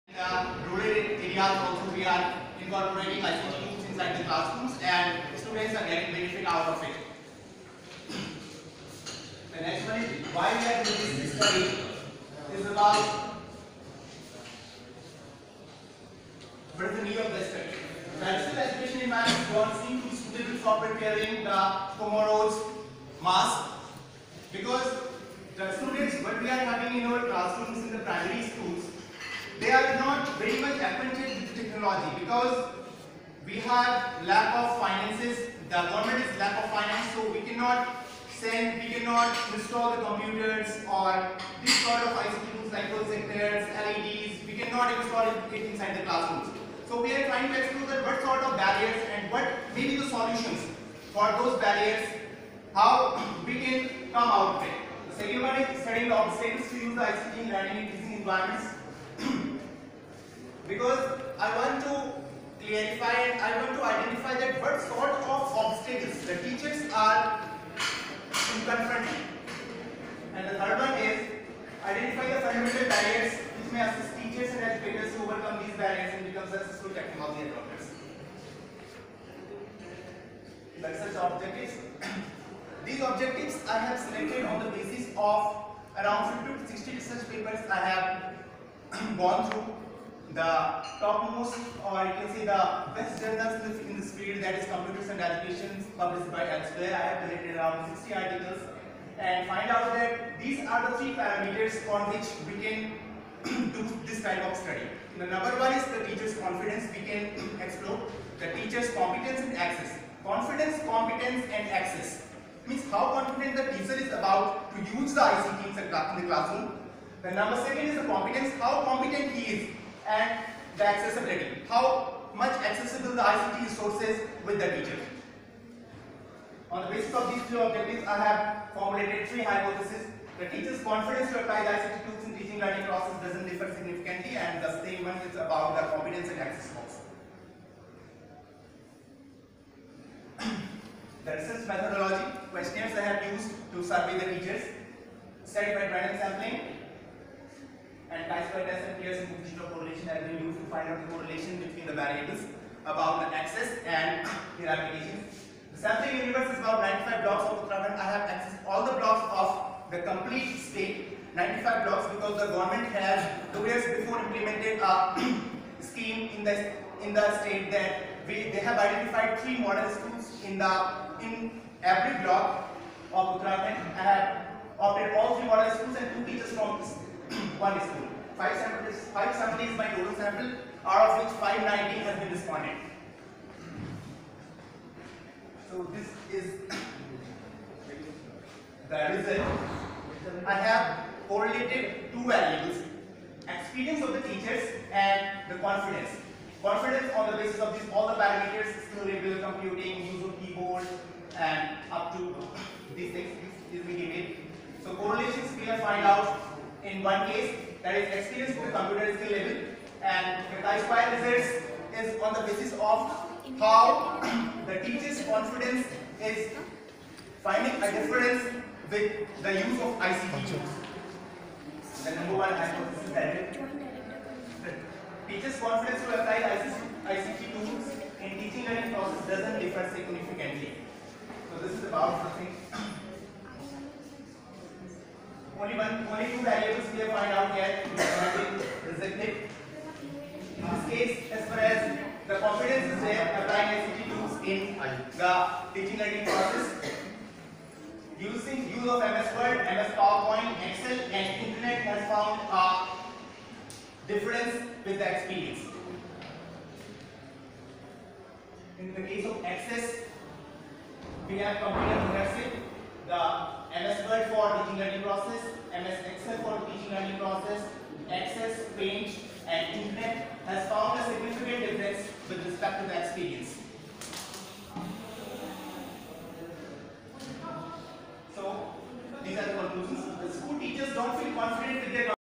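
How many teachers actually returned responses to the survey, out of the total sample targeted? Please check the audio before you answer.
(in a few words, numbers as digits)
590.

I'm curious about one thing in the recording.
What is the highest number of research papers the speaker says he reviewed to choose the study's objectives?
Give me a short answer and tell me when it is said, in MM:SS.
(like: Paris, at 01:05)
60, at 01:26.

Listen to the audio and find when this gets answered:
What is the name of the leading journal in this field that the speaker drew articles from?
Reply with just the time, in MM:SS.
01:34.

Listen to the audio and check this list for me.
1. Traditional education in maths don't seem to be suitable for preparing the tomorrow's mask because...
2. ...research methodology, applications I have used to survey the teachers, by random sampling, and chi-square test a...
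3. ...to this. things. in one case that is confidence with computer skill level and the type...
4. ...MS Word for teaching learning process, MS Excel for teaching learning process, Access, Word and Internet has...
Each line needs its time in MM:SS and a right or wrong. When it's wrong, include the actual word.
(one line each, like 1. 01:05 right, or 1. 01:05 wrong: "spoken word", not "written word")
1. 00:18 right
2. 02:21 wrong: "questions", not "applications"
3. 03:22 wrong: "experience", not "confidence"
4. 04:23 wrong: "Paint", not "Word".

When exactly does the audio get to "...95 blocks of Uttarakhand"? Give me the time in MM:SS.
02:37.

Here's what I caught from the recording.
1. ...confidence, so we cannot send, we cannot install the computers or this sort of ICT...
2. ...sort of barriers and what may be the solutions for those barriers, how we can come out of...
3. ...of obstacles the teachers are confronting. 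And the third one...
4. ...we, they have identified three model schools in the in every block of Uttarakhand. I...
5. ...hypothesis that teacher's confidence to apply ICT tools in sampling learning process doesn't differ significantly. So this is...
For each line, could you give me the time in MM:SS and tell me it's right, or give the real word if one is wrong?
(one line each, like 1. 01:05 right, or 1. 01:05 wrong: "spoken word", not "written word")
1. 00:36 wrong: "finance", not "confidence"
2. 00:48 right
3. 01:05 right
4. 02:48 right
5. 03:42 wrong: "teaching", not "sampling".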